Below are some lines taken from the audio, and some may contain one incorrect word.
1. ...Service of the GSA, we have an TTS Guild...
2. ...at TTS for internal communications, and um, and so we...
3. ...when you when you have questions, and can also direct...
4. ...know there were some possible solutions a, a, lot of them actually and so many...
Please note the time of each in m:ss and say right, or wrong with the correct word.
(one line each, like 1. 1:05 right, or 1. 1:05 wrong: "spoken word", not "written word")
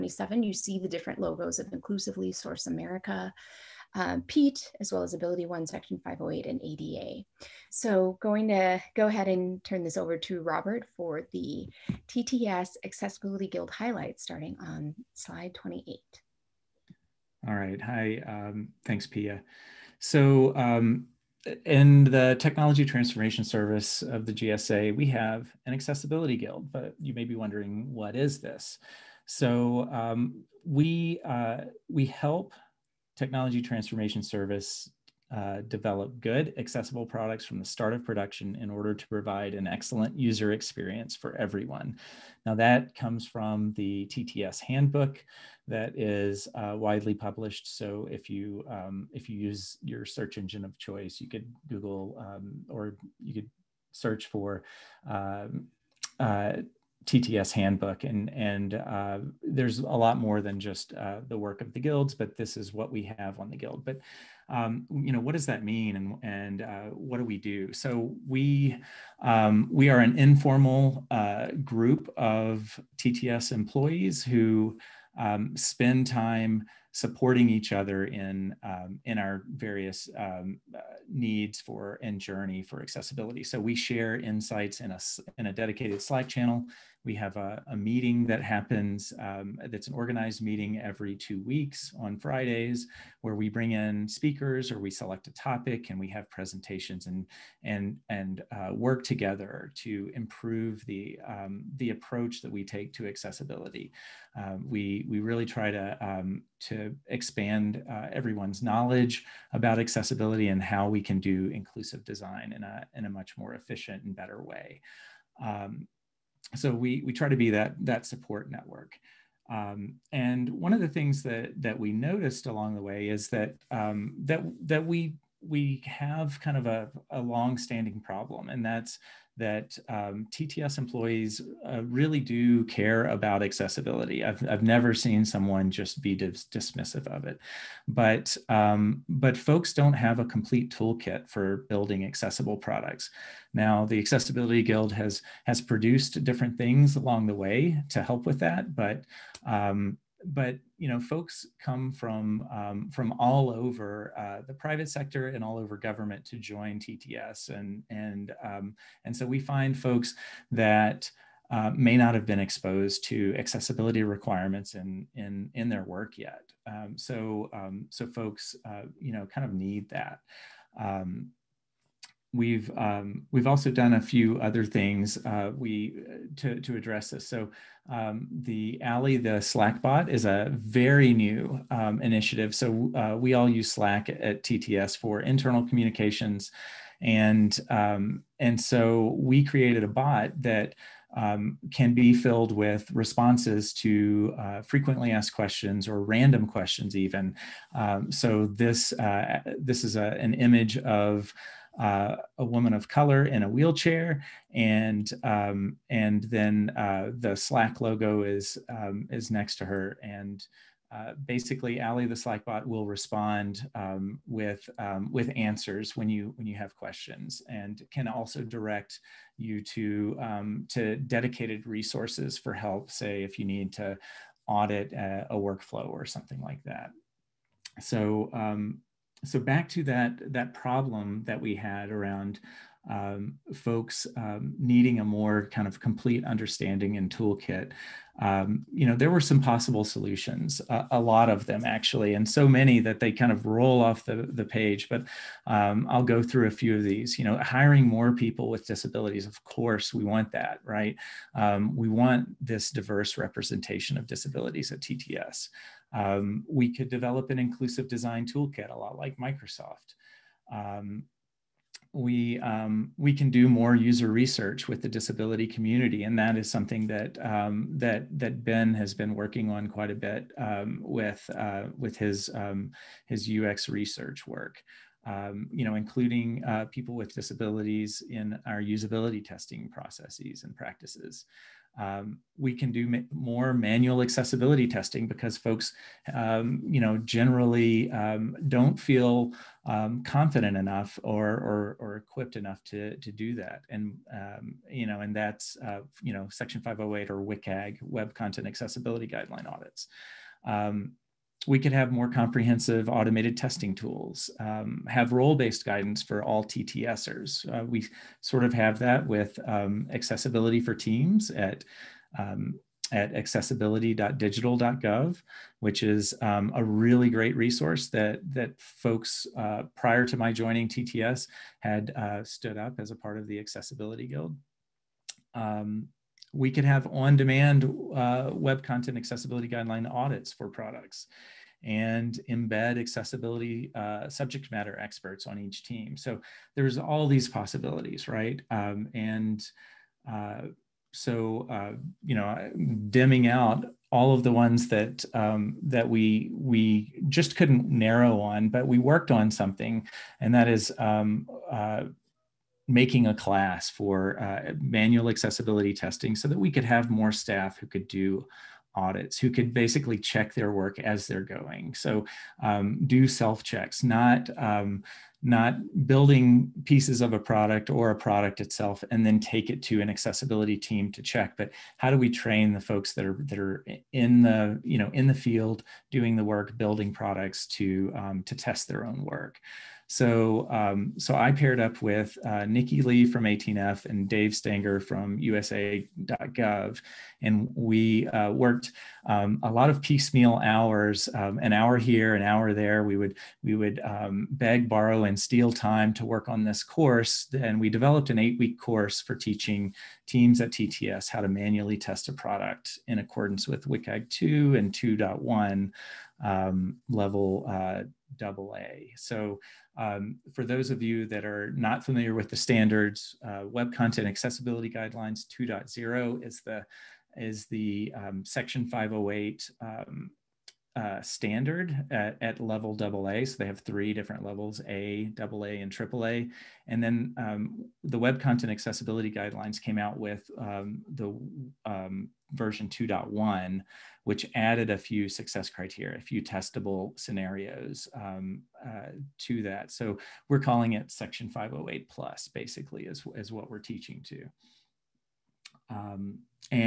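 1. 0:23 wrong: "Accessibility", not "TTS"
2. 3:04 right
3. 3:35 right
4. 3:58 right.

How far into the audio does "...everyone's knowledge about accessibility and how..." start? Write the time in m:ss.
1:48.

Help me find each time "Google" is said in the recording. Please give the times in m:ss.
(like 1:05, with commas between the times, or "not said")
0:51.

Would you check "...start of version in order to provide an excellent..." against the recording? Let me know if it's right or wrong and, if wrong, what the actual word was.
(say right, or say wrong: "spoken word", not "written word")
wrong: "production", not "version".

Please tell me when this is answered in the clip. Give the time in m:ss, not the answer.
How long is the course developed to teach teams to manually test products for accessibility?
6:38.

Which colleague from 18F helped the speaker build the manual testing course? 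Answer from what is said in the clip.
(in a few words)
Nikki Lee.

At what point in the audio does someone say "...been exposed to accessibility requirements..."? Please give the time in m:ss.
2:42.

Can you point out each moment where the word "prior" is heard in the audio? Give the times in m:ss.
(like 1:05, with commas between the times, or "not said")
5:19.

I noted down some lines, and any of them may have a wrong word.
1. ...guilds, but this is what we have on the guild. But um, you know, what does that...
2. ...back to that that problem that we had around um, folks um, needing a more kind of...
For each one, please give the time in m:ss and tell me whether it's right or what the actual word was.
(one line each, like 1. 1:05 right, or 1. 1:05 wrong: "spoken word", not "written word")
1. 1:01 right
2. 3:49 right.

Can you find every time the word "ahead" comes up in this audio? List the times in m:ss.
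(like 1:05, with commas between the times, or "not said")
0:09.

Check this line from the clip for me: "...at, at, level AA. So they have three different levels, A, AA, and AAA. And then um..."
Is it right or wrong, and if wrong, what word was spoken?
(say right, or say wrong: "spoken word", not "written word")
right.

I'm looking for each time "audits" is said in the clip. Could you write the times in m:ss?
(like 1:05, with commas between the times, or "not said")
3:44, 4:59, 5:29, 5:58.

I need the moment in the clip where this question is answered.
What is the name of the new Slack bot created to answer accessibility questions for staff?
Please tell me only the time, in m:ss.
2:58.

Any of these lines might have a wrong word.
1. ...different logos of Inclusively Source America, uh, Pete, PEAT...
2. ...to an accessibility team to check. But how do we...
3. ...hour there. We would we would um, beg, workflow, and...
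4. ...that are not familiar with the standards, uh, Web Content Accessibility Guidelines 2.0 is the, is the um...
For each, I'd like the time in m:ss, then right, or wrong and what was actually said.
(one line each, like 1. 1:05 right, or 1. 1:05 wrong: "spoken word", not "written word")
1. 0:00 right
2. 6:09 right
3. 6:32 wrong: "borrow", not "workflow"
4. 6:51 right.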